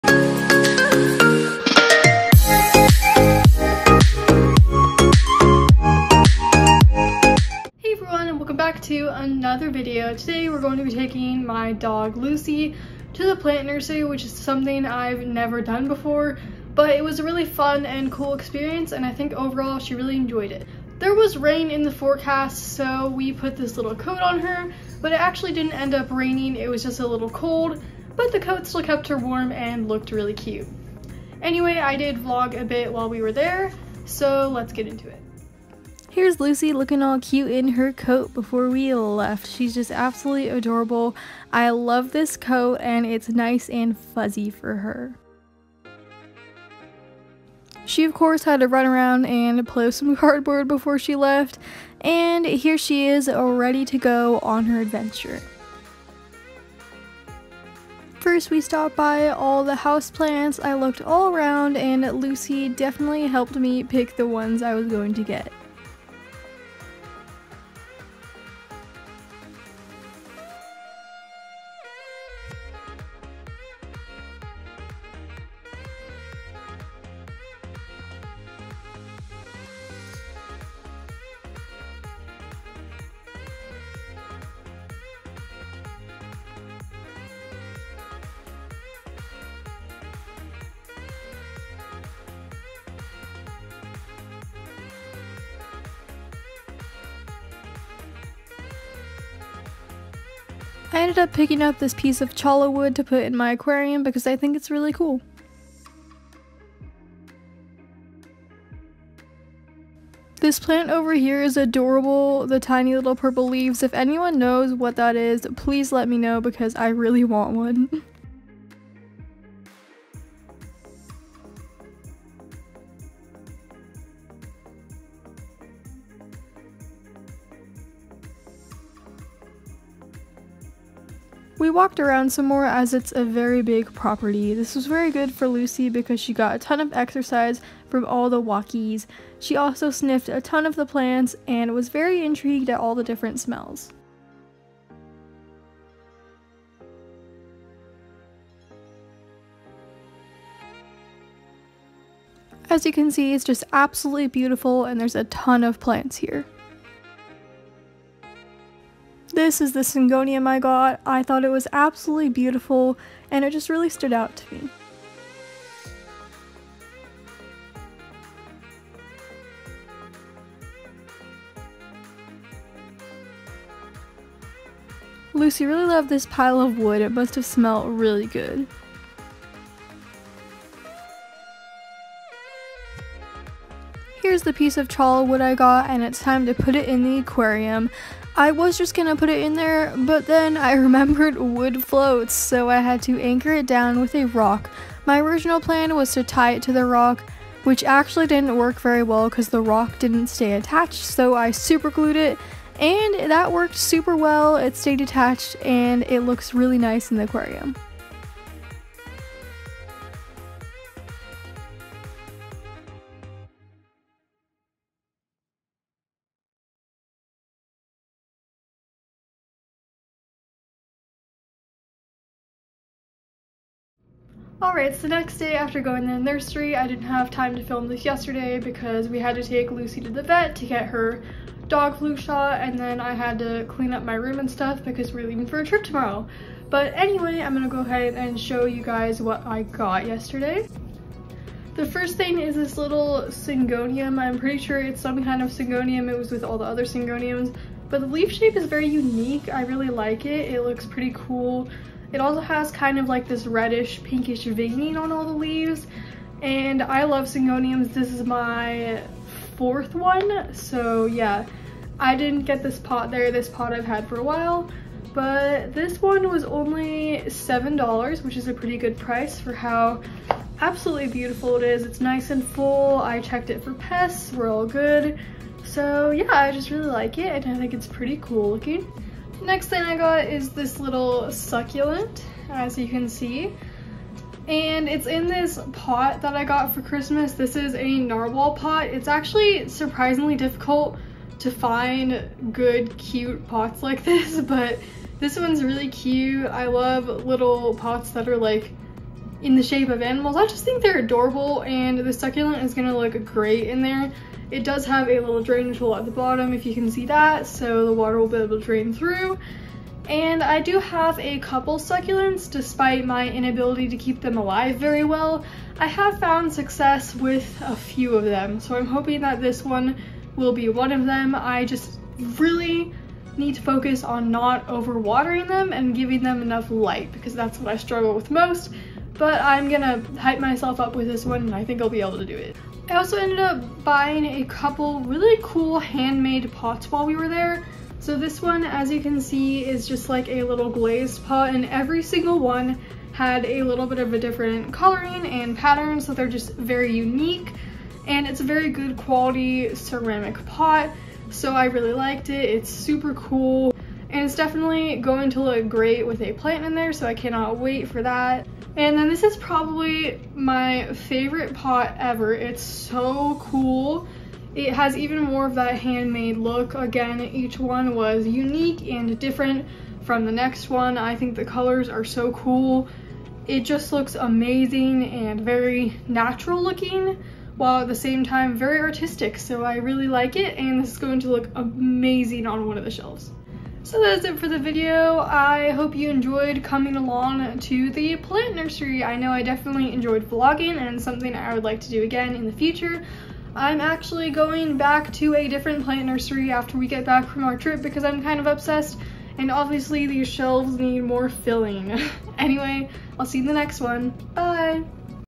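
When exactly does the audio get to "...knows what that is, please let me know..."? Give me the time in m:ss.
1:54.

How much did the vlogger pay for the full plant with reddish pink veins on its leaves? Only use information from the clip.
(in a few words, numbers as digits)
$7.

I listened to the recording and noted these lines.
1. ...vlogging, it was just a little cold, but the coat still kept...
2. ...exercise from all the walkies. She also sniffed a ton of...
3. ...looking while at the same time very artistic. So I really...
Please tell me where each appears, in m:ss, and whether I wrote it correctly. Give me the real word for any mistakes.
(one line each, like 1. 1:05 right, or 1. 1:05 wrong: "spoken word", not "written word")
1. 0:26 wrong: "raining", not "vlogging"
2. 2:16 right
3. 6:16 right.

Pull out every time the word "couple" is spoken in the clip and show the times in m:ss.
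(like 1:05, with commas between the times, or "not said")
5:11, 5:34.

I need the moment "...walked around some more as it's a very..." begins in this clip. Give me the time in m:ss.
2:11.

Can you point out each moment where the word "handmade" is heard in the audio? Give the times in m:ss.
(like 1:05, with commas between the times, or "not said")
5:35, 6:05.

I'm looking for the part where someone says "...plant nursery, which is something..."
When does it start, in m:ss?
0:13.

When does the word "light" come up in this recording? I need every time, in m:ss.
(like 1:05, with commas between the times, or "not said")
5:26.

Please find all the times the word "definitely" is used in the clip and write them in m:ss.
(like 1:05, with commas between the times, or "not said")
1:02, 5:54, 6:29.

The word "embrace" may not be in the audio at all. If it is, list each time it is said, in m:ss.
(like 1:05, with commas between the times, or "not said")
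not said.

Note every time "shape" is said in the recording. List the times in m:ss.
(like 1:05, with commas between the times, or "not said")
4:08, 4:59.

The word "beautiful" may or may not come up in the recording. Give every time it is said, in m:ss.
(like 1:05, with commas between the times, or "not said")
2:34, 2:42, 4:31.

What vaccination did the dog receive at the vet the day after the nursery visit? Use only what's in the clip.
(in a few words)
dog flu shot.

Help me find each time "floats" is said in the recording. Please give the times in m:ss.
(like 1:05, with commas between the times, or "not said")
3:11.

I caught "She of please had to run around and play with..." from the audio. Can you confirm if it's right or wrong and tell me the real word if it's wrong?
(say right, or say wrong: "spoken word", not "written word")
wrong: "course", not "please".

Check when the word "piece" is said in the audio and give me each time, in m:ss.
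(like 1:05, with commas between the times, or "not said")
1:41, 3:04.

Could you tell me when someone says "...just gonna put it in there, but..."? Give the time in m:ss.
3:08.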